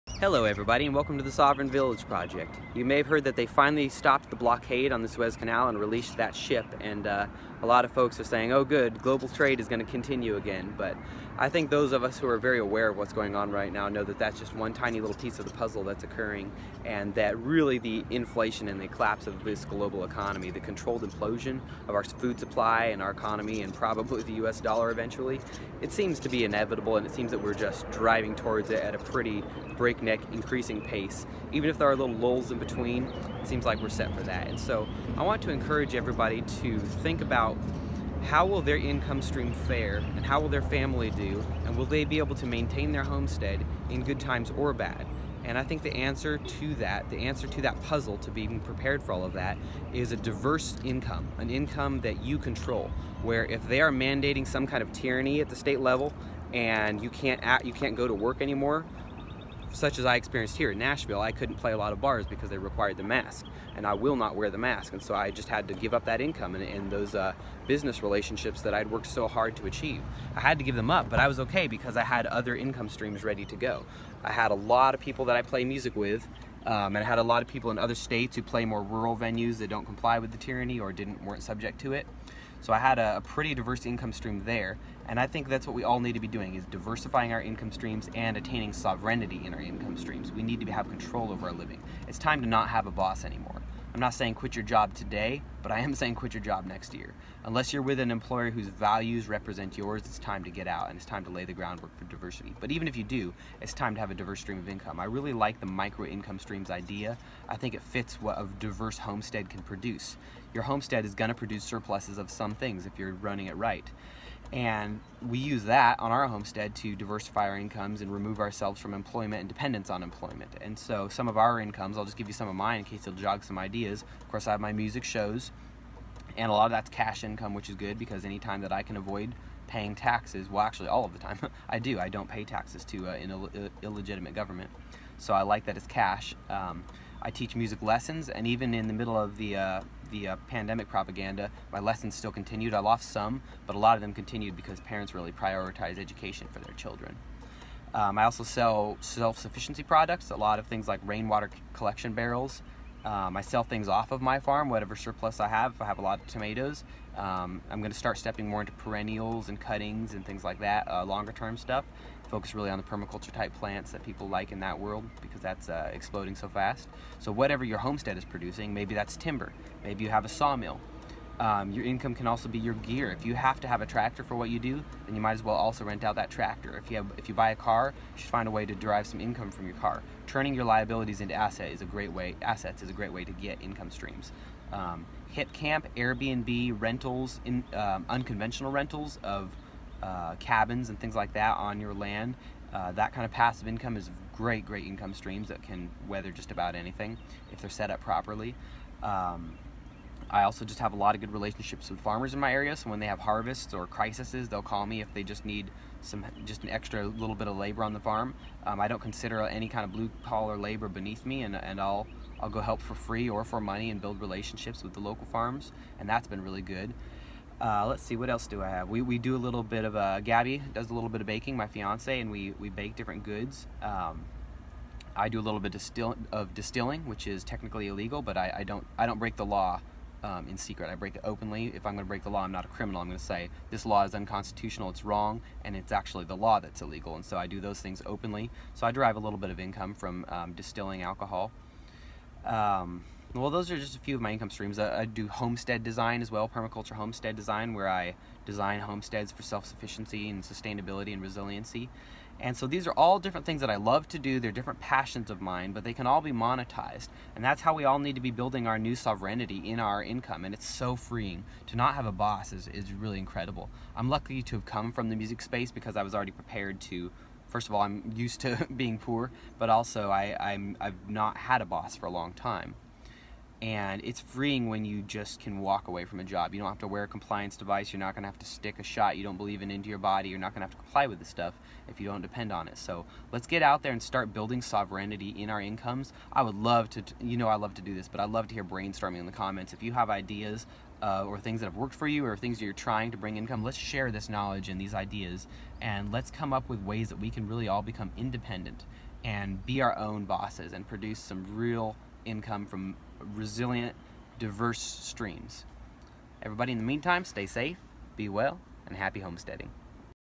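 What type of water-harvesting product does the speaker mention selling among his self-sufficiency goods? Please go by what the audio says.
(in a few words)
rainwater collection barrels.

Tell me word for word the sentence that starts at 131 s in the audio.
I don't pay taxes to uh, an Ill illegitimate government.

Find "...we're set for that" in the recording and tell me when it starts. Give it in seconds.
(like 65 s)
33 s.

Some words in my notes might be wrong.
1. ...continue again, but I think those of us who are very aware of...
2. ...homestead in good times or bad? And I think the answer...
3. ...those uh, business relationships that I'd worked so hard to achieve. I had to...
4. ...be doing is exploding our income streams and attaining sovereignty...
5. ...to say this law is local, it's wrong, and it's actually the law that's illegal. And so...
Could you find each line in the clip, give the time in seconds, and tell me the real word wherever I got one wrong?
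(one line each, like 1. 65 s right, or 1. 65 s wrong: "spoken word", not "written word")
1. 9 s right
2. 43 s right
3. 66 s right
4. 86 s wrong: "diversifying", not "exploding"
5. 233 s wrong: "unconstitutional", not "local".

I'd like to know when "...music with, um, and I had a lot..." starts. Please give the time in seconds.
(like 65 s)
75 s.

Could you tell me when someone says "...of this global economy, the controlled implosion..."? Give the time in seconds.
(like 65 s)
19 s.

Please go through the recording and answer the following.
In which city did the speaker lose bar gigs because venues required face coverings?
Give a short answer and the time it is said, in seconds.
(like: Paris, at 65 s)
Nashville, at 60 s.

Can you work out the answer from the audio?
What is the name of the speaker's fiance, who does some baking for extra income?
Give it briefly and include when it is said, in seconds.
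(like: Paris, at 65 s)
Gabby, at 220 s.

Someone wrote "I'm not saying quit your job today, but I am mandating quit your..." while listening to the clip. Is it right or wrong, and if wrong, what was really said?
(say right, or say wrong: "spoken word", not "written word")
wrong: "saying", not "mandating".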